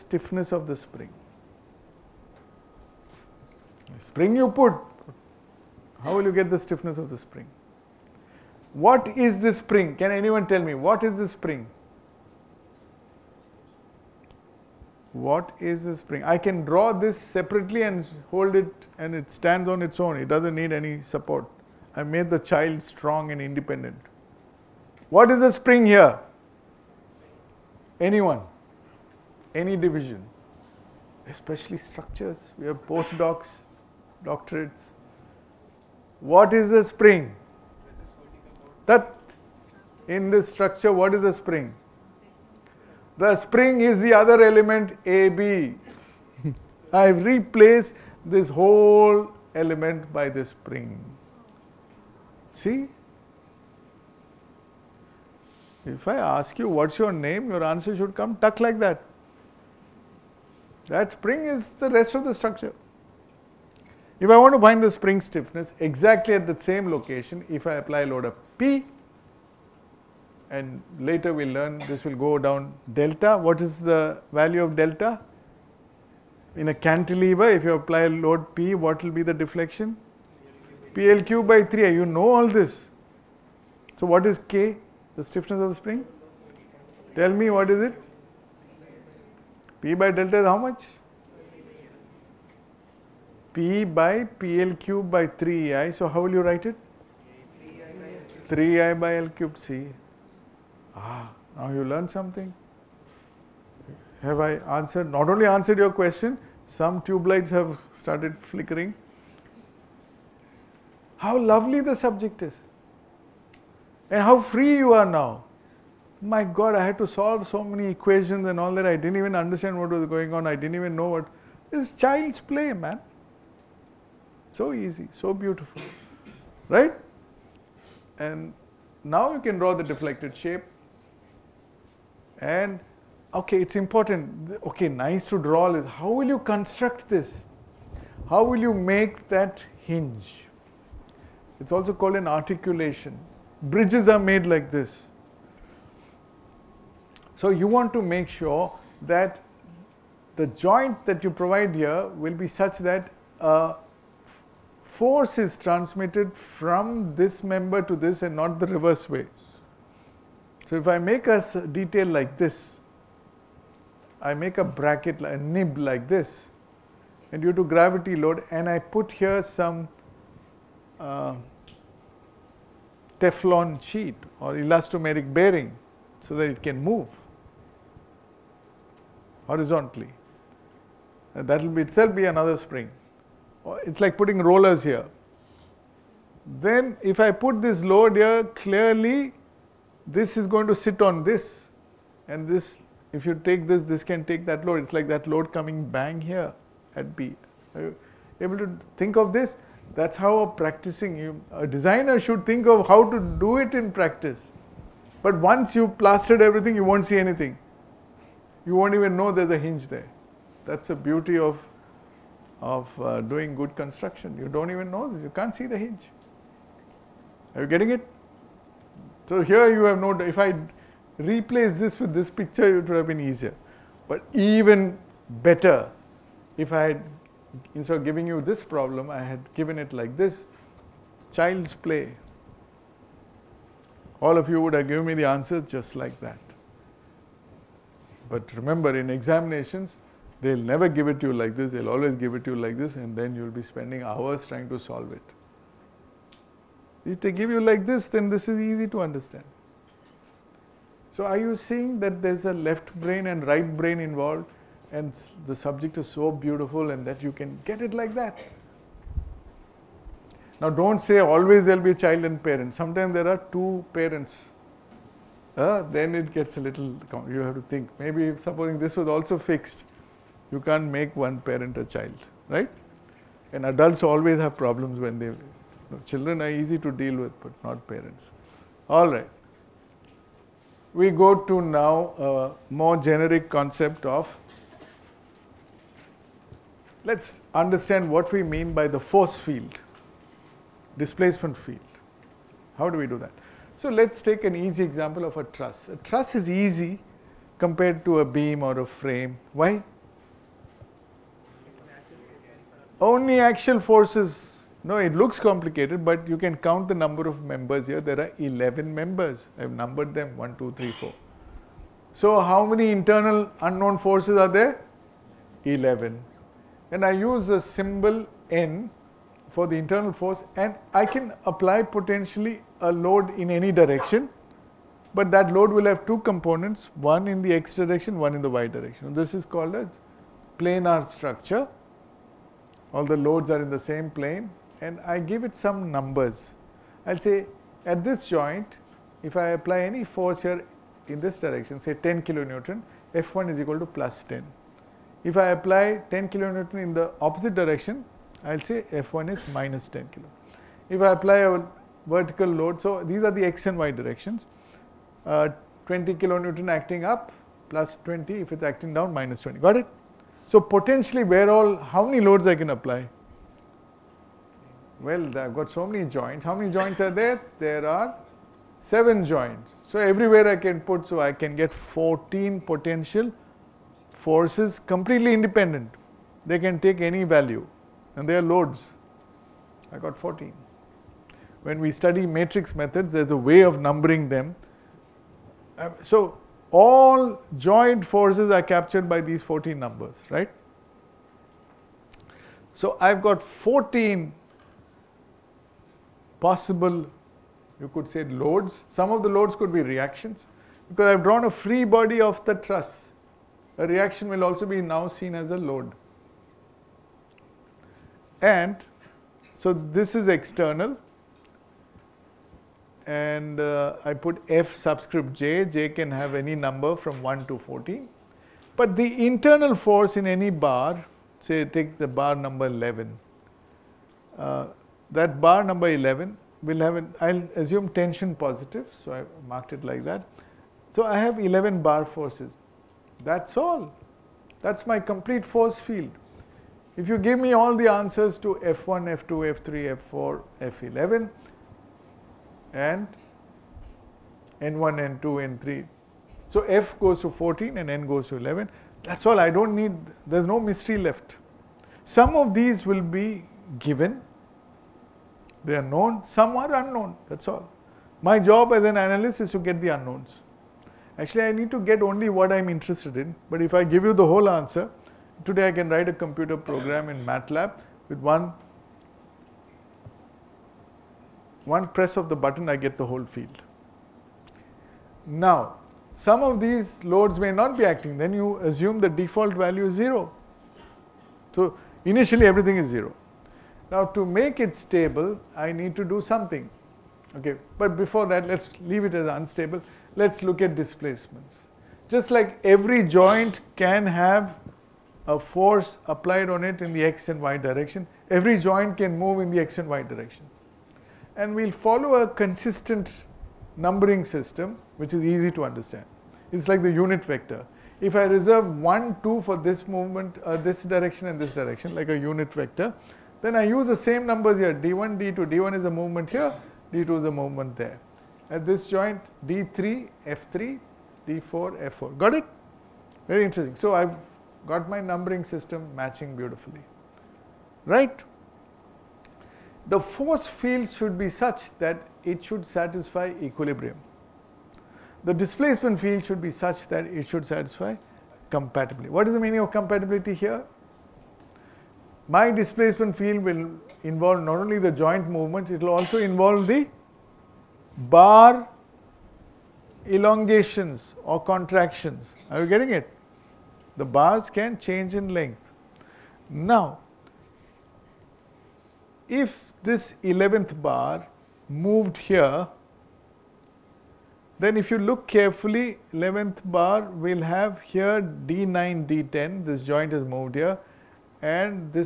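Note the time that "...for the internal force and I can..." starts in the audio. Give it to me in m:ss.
5:19.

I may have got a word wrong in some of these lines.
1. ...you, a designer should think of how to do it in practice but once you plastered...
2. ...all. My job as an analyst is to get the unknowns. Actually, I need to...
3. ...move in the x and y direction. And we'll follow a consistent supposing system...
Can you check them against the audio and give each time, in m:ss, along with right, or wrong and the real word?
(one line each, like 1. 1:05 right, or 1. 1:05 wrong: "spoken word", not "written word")
1. 3:21 right
2. 7:37 right
3. 8:19 wrong: "numbering", not "supposing".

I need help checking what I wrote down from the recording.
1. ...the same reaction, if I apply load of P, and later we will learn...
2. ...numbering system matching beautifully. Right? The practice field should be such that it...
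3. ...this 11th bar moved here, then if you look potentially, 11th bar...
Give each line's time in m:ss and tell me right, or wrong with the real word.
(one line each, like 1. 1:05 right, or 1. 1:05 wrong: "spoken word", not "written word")
1. 1:06 wrong: "location", not "reaction"
2. 8:45 wrong: "force", not "practice"
3. 9:19 wrong: "carefully", not "potentially".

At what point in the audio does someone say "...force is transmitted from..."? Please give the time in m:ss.
2:34.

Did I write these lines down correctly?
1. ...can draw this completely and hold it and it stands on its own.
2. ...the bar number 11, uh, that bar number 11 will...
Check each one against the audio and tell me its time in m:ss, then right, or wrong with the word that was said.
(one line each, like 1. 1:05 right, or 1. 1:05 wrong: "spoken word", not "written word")
1. 0:16 wrong: "separately", not "completely"
2. 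7:01 right.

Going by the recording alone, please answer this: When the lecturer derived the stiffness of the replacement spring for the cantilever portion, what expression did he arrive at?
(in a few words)
3EI/L³.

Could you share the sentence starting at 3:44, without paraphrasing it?
But even better, if I had, instead of giving you this problem, I had given it like this child's play.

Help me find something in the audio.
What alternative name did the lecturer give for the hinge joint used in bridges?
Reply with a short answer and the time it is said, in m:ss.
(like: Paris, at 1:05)
articulation, at 2:22.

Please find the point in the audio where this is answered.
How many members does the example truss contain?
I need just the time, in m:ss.
5:08.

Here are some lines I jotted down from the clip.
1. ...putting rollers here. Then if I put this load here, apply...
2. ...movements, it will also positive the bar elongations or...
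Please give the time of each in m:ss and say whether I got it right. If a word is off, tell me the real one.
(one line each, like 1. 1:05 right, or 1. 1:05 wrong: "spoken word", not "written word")
1. 3:04 wrong: "clearly", not "apply"
2. 9:05 wrong: "involve", not "positive".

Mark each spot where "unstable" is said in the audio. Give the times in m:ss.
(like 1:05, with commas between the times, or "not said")
8:09.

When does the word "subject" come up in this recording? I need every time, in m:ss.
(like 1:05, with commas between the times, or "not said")
1:51, 4:15.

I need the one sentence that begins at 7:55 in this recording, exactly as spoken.
Now, some of these loads may not be acting, then you assume the default value is zero.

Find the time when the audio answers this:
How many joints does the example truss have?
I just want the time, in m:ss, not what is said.
6:08.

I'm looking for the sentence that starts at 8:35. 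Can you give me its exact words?
D1 is a movement here, D2 is a movement there.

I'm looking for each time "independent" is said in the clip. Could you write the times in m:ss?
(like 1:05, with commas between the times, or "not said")
0:23, 6:15.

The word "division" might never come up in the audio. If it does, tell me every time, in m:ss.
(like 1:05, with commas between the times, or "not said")
0:29.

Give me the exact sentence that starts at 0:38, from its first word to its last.
That in this structure, what is a spring?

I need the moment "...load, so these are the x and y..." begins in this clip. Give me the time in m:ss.
5:52.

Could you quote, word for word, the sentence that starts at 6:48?
And so this is external and uh, I put F subscript J, J can have any number from 1 to 14.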